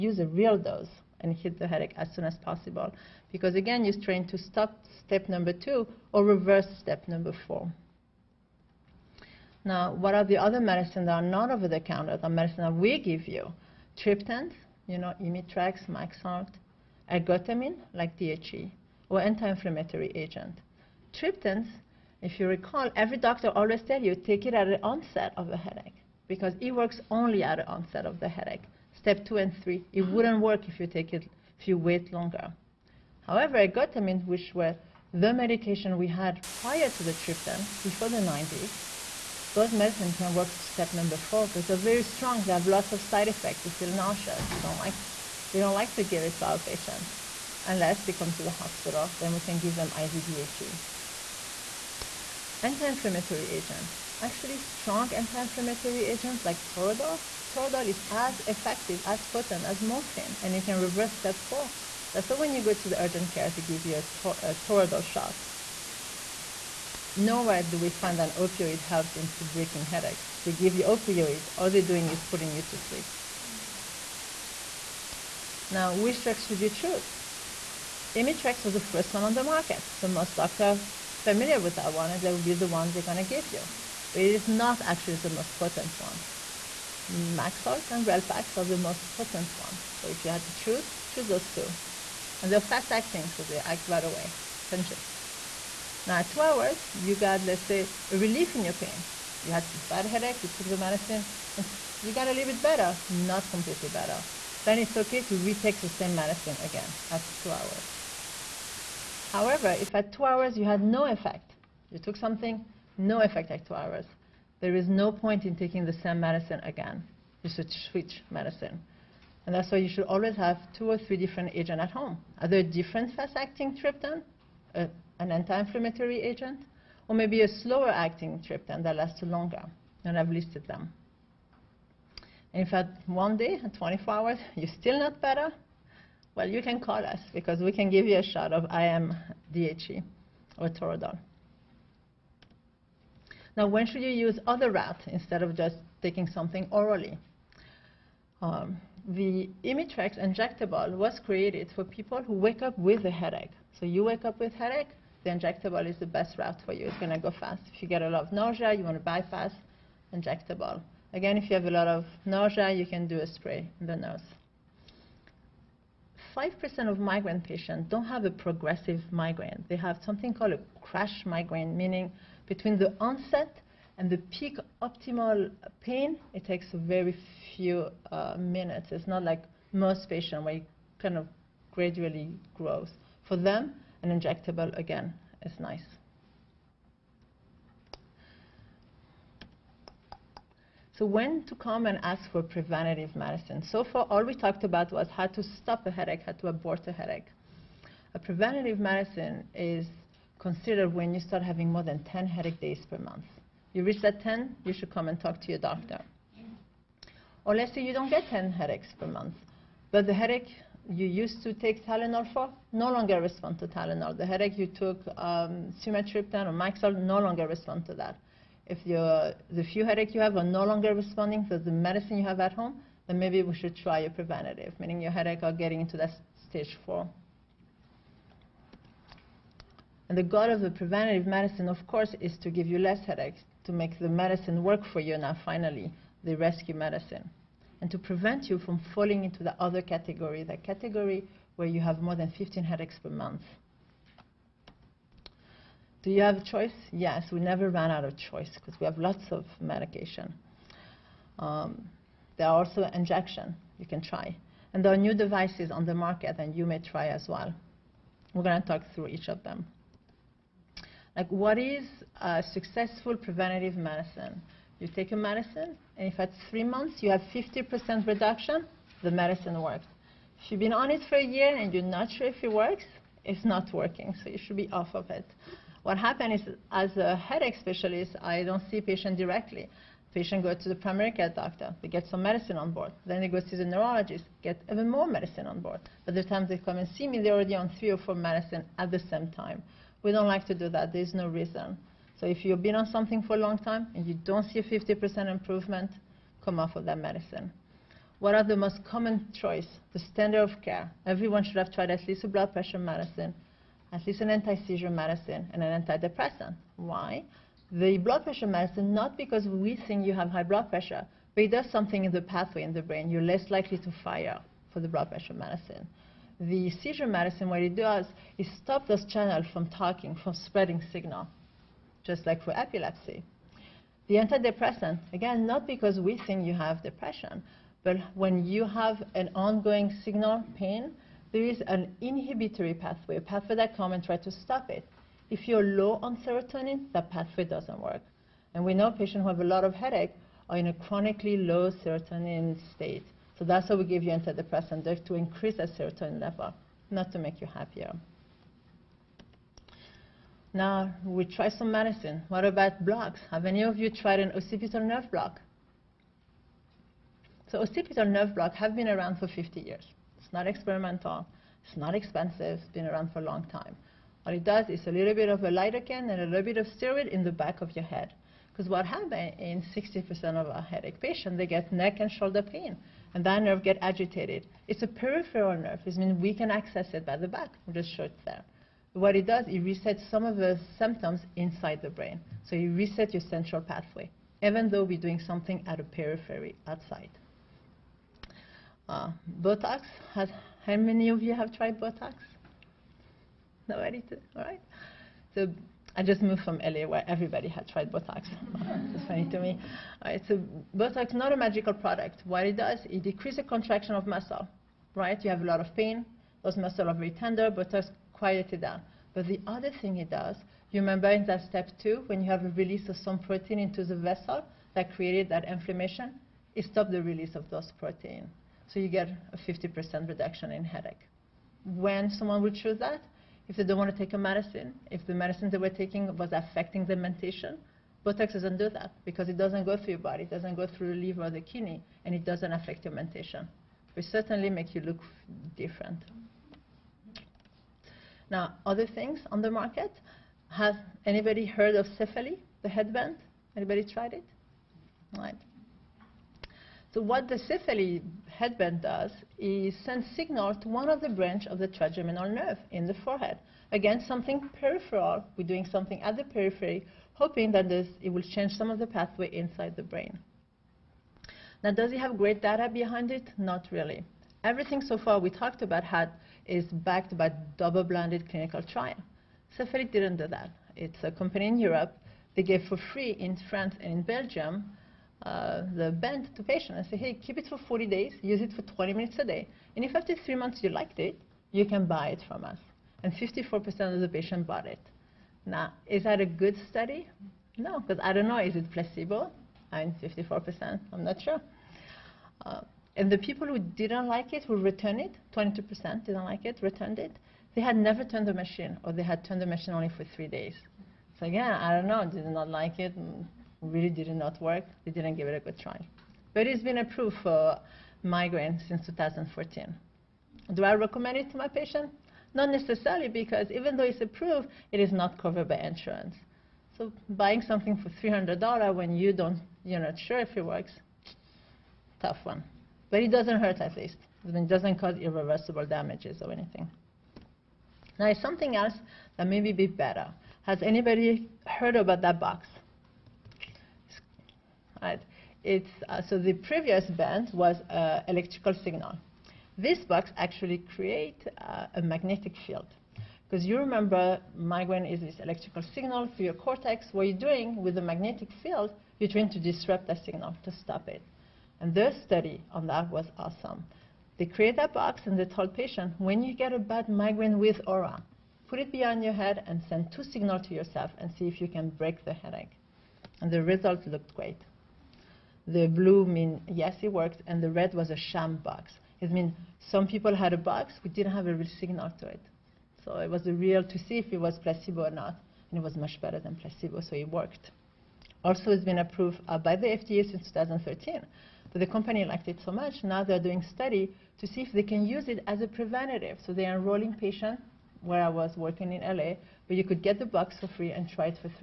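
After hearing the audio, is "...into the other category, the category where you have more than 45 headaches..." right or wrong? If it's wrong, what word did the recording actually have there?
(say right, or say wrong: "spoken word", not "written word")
wrong: "15", not "45".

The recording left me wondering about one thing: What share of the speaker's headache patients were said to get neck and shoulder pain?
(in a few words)
60%.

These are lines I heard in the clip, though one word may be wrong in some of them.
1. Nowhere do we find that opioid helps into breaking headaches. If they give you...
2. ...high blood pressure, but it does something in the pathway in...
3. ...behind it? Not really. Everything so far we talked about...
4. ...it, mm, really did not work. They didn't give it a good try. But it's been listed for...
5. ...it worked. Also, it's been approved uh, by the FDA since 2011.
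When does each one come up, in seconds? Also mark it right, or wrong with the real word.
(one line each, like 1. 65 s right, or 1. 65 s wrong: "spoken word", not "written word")
1. 67 s right
2. 310 s right
3. 462 s right
4. 502 s wrong: "approved", not "listed"
5. 576 s wrong: "2013", not "2011".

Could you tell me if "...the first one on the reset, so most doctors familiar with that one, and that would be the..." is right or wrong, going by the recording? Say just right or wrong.
wrong.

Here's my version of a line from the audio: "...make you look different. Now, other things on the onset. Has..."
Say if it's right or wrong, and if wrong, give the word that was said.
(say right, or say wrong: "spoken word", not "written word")
wrong: "market", not "onset".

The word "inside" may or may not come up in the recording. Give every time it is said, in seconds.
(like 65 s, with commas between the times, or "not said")
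381 s, 459 s.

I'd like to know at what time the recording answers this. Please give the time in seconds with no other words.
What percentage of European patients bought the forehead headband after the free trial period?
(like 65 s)
483 s.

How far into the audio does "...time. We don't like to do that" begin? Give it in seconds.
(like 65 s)
289 s.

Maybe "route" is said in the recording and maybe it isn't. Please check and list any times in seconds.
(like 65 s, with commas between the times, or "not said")
144 s, 156 s.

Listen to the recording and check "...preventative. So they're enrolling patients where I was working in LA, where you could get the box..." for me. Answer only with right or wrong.
right.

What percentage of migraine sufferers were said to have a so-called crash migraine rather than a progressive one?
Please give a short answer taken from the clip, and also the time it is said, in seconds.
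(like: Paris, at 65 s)
5%, at 166 s.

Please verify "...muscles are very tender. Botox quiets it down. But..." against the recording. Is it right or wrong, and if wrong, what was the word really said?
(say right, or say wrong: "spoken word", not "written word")
right.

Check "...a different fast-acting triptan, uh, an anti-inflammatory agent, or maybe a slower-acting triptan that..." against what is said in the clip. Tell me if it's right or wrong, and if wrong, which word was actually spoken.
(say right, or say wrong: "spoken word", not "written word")
right.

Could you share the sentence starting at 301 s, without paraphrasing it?
Everyone should have tried at least a blood pressure medicine, at least an anti-seizure medicine, and an antidepressant.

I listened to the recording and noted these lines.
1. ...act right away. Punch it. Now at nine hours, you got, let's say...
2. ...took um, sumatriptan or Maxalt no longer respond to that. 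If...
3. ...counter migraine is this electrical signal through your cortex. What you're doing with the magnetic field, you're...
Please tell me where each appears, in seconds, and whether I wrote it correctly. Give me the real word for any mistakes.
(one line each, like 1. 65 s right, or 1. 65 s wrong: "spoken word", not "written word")
1. 93 s wrong: "two", not "nine"
2. 214 s right
3. 543 s wrong: "remember", not "counter".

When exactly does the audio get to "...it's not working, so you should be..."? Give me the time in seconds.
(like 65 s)
273 s.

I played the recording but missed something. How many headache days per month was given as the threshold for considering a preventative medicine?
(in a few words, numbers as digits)
10.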